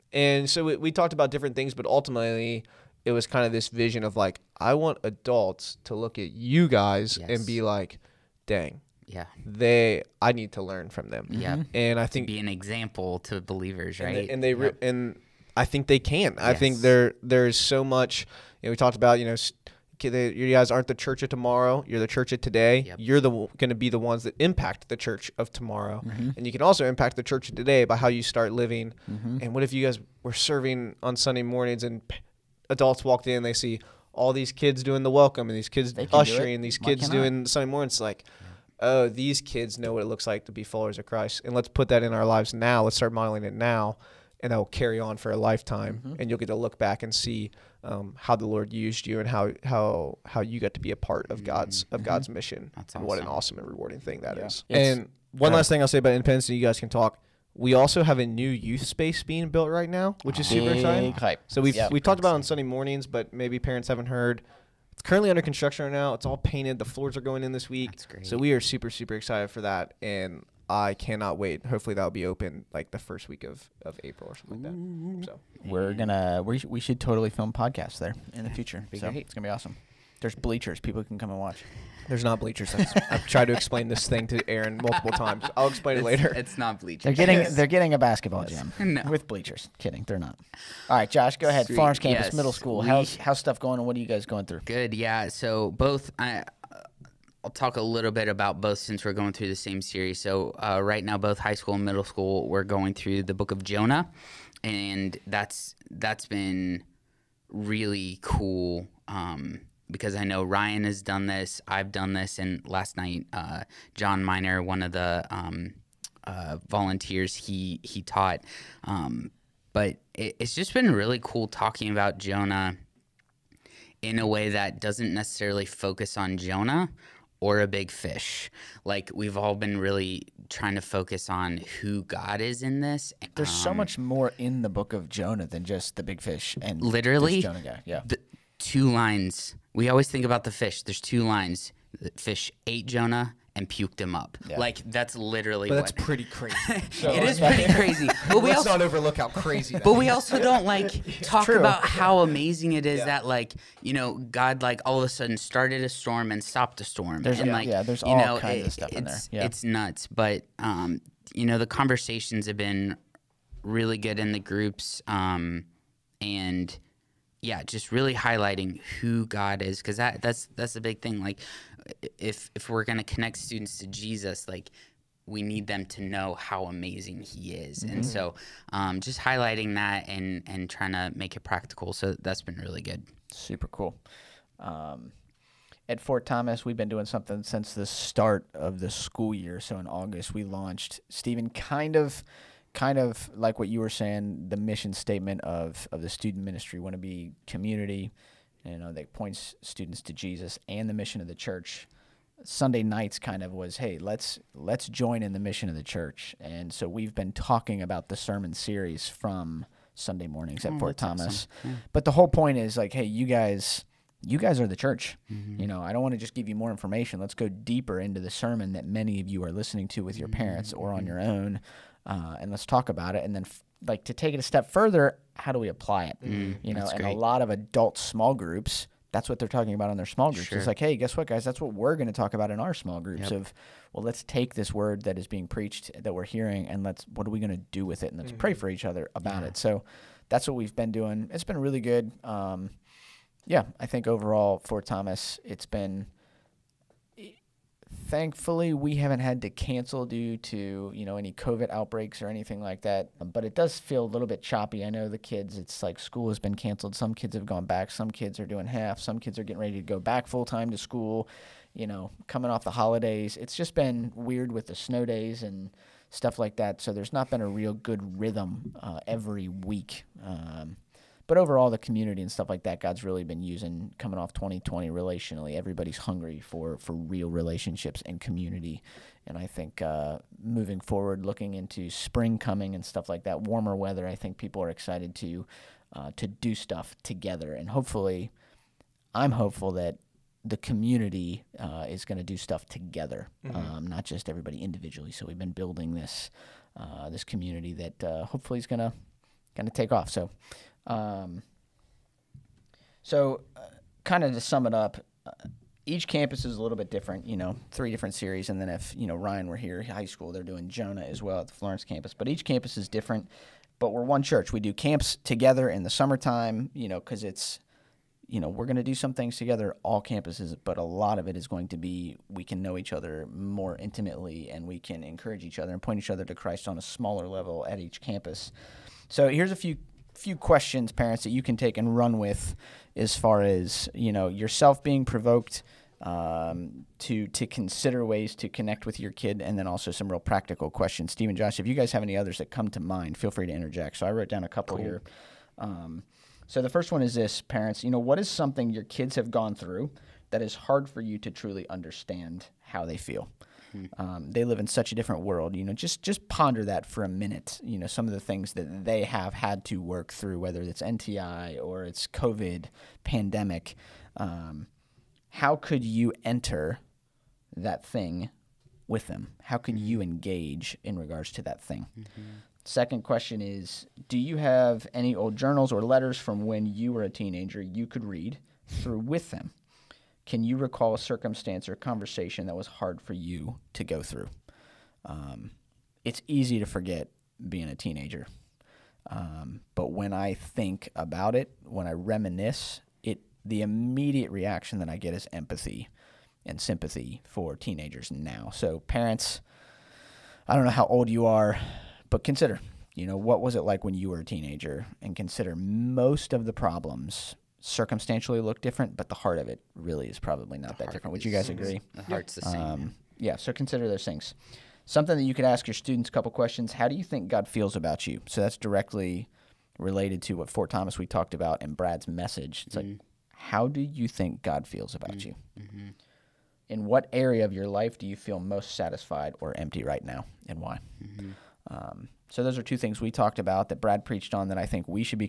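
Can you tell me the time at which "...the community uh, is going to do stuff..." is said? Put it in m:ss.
4:50.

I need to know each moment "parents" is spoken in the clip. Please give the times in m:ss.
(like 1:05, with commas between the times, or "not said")
1:03, 3:40, 5:30, 5:47, 6:38.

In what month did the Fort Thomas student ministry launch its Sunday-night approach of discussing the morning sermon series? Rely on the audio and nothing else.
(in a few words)
August.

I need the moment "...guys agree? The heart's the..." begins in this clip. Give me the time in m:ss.
6:51.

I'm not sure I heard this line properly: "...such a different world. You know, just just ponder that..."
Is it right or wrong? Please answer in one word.
right.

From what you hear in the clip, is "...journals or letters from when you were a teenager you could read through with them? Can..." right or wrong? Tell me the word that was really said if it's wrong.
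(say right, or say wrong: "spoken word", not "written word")
right.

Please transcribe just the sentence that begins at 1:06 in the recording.
The floors are going in this week.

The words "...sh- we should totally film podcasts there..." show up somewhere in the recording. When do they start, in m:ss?
1:16.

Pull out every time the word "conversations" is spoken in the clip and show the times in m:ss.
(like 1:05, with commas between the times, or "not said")
2:41, 6:21.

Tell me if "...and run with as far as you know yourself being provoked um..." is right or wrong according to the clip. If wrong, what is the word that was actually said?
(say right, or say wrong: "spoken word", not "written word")
right.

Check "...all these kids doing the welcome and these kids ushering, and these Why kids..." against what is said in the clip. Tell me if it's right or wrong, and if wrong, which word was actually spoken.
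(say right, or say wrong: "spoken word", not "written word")
right.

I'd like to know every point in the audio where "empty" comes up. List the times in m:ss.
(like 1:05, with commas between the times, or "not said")
7:09.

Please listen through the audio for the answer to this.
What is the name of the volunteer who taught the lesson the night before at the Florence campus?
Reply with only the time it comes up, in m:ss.
1:53.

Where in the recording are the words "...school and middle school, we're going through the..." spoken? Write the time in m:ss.
1:41.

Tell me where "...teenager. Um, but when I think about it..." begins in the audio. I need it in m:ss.
6:27.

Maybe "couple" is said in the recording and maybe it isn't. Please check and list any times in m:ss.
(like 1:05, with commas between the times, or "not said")
5:44, 6:56.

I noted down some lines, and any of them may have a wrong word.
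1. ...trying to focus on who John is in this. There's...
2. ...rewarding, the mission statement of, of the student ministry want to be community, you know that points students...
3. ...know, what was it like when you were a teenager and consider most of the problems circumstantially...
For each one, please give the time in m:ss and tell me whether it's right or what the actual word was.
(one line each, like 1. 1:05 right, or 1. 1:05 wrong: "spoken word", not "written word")
1. 2:10 wrong: "God", not "John"
2. 3:13 wrong: "saying", not "rewarding"
3. 6:43 right.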